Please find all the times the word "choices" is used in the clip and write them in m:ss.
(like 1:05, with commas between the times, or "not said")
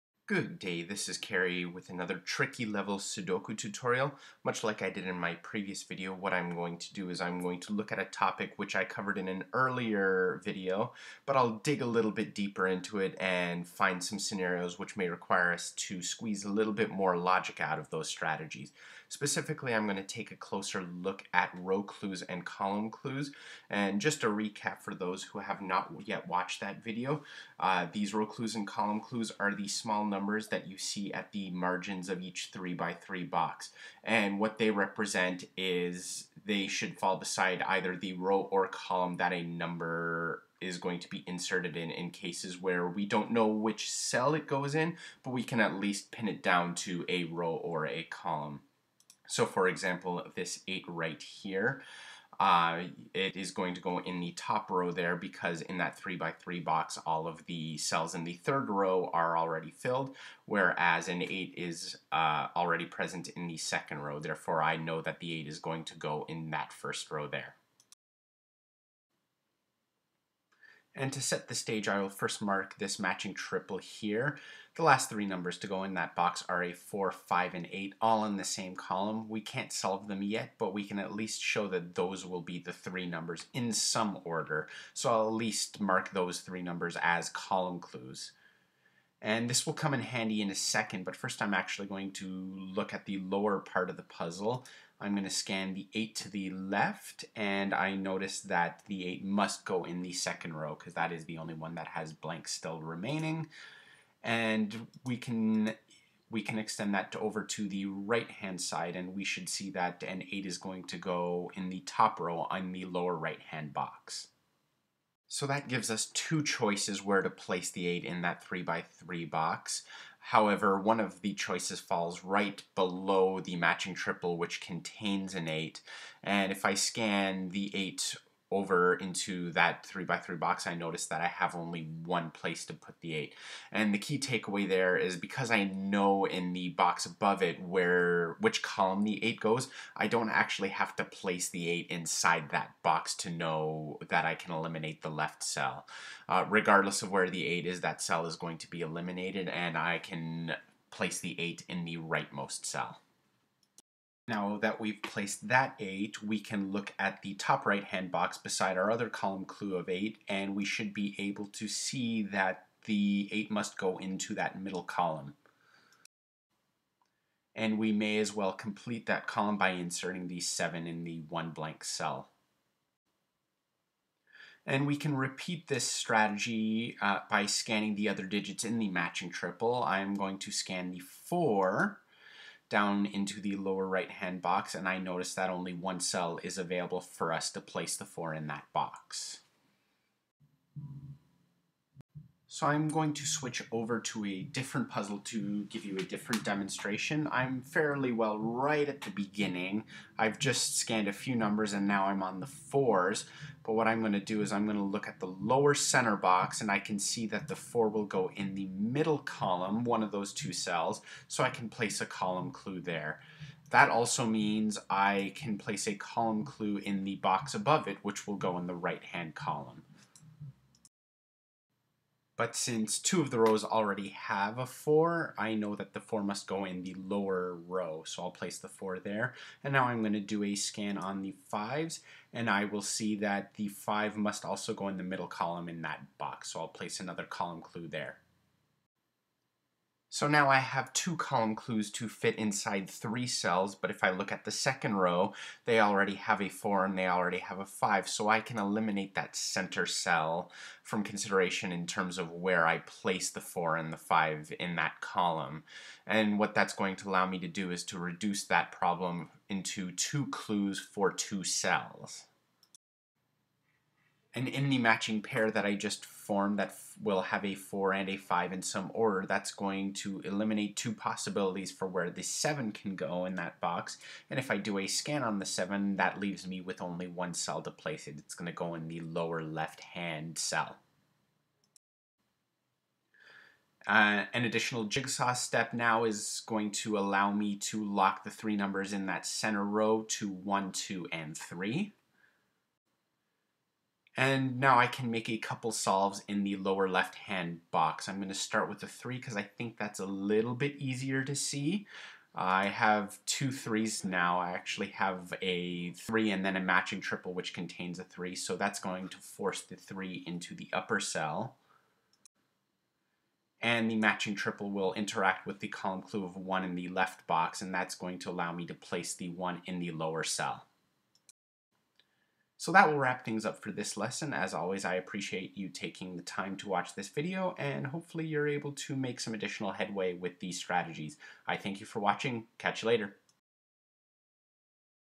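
1:56, 2:01.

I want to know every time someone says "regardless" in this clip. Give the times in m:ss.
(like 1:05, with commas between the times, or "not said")
2:26.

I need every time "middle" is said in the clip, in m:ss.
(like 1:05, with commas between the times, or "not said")
2:44, 3:28, 3:55.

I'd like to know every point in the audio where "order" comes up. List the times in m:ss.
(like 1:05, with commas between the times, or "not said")
1:24, 4:28.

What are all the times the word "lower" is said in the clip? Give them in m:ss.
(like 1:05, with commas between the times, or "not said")
1:33, 1:52, 3:03, 3:25, 3:46, 4:39, 4:56, 5:19.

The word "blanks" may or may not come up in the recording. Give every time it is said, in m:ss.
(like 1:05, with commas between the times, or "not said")
1:42, 2:51.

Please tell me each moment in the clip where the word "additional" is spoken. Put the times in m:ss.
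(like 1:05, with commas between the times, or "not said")
4:44, 5:29.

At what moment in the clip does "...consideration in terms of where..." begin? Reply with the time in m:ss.
4:11.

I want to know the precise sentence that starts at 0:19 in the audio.
Specifically, I'm going to take a closer look at row clues and column clues.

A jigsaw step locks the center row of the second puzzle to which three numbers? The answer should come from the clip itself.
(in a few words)
1, 2, and 3.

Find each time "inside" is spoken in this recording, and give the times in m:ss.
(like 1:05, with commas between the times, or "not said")
2:21, 4:02.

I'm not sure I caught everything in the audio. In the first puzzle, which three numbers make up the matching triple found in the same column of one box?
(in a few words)
4, 5, and 8.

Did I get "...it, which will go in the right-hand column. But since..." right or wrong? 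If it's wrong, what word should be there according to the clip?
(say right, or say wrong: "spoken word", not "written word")
right.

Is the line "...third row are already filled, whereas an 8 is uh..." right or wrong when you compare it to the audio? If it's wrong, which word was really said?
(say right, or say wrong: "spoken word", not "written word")
right.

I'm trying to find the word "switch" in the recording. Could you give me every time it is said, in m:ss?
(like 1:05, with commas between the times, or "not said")
3:13.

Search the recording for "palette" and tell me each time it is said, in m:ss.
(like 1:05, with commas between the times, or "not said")
not said.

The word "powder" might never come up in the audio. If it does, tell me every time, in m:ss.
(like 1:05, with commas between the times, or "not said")
not said.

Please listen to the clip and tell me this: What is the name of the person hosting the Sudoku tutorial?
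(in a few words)
Cary.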